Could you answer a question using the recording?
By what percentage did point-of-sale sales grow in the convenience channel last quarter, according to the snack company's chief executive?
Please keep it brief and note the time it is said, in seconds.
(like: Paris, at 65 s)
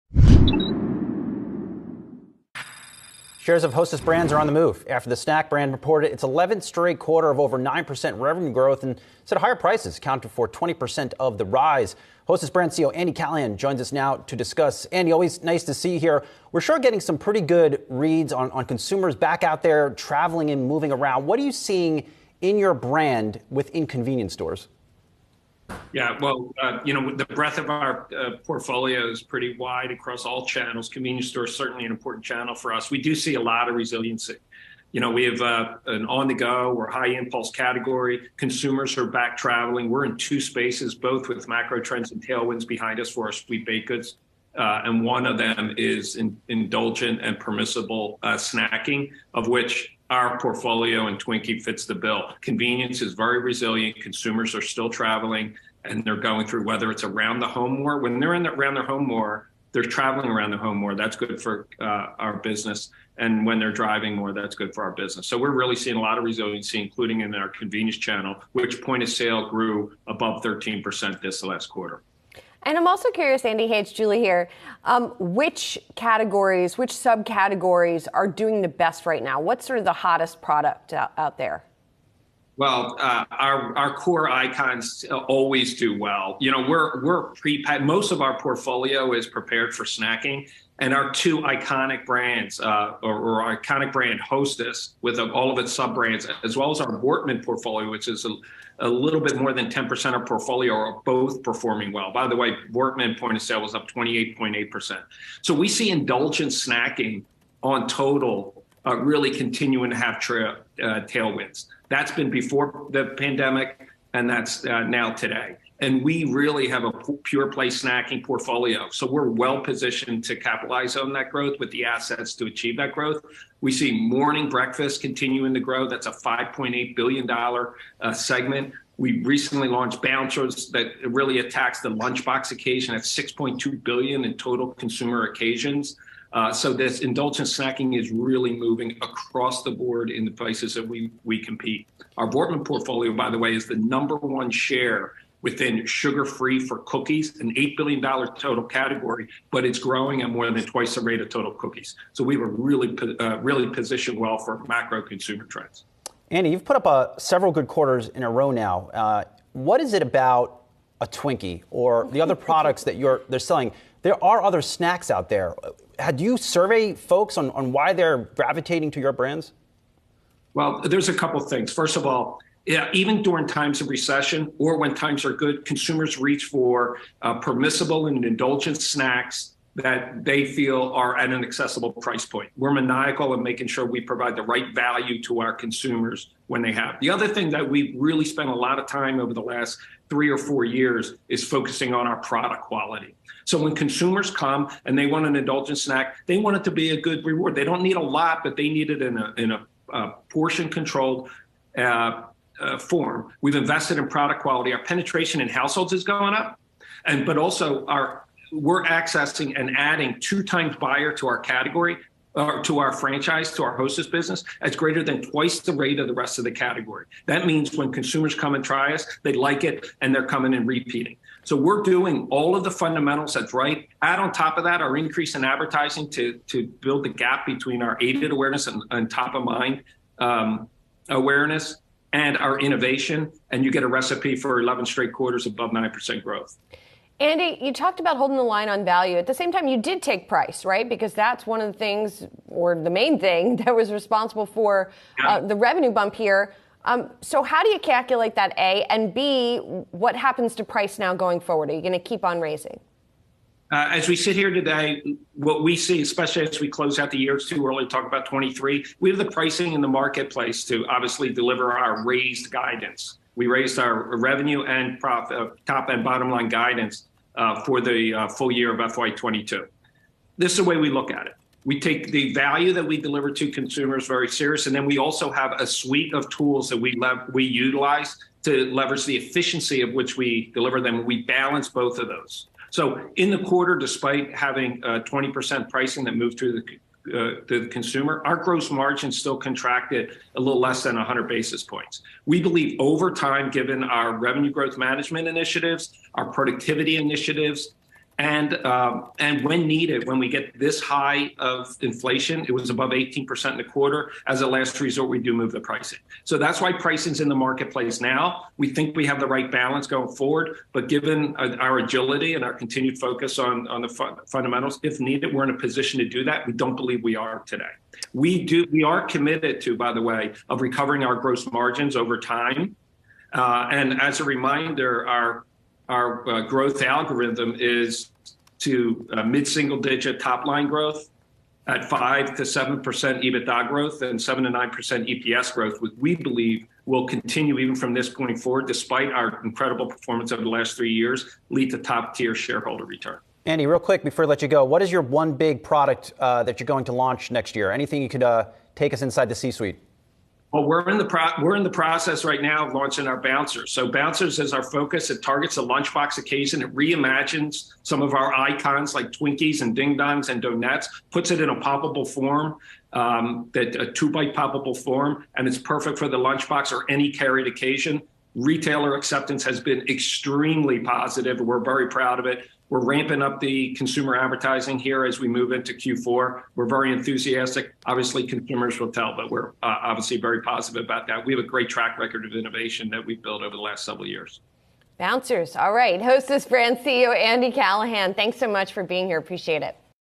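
13%, at 70 s.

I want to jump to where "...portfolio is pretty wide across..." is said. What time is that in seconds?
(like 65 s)
28 s.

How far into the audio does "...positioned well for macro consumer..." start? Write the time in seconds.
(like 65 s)
153 s.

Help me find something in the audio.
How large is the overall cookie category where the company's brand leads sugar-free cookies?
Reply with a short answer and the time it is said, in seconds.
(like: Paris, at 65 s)
$8 billion, at 147 s.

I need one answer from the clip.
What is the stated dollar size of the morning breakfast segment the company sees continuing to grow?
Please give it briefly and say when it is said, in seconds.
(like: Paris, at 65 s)
$5.8 billion, at 126 s.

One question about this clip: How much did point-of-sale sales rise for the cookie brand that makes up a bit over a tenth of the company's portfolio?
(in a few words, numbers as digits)
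28.8%.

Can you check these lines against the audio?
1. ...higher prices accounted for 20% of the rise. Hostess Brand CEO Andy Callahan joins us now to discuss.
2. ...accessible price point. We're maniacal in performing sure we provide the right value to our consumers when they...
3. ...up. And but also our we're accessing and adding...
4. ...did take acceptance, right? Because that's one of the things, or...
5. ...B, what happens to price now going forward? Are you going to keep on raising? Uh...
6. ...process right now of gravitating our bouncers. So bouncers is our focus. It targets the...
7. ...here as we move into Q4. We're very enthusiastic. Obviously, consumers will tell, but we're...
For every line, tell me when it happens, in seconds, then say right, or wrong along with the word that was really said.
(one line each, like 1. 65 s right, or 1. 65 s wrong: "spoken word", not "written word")
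1. 9 s right
2. 181 s wrong: "making", not "performing"
3. 206 s right
4. 239 s wrong: "price", not "acceptance"
5. 249 s right
6. 351 s wrong: "launching", not "gravitating"
7. 374 s right.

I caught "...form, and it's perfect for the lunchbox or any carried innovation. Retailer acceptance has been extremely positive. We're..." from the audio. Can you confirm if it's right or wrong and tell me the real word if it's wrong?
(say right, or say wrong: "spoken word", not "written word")
wrong: "occasion", not "innovation".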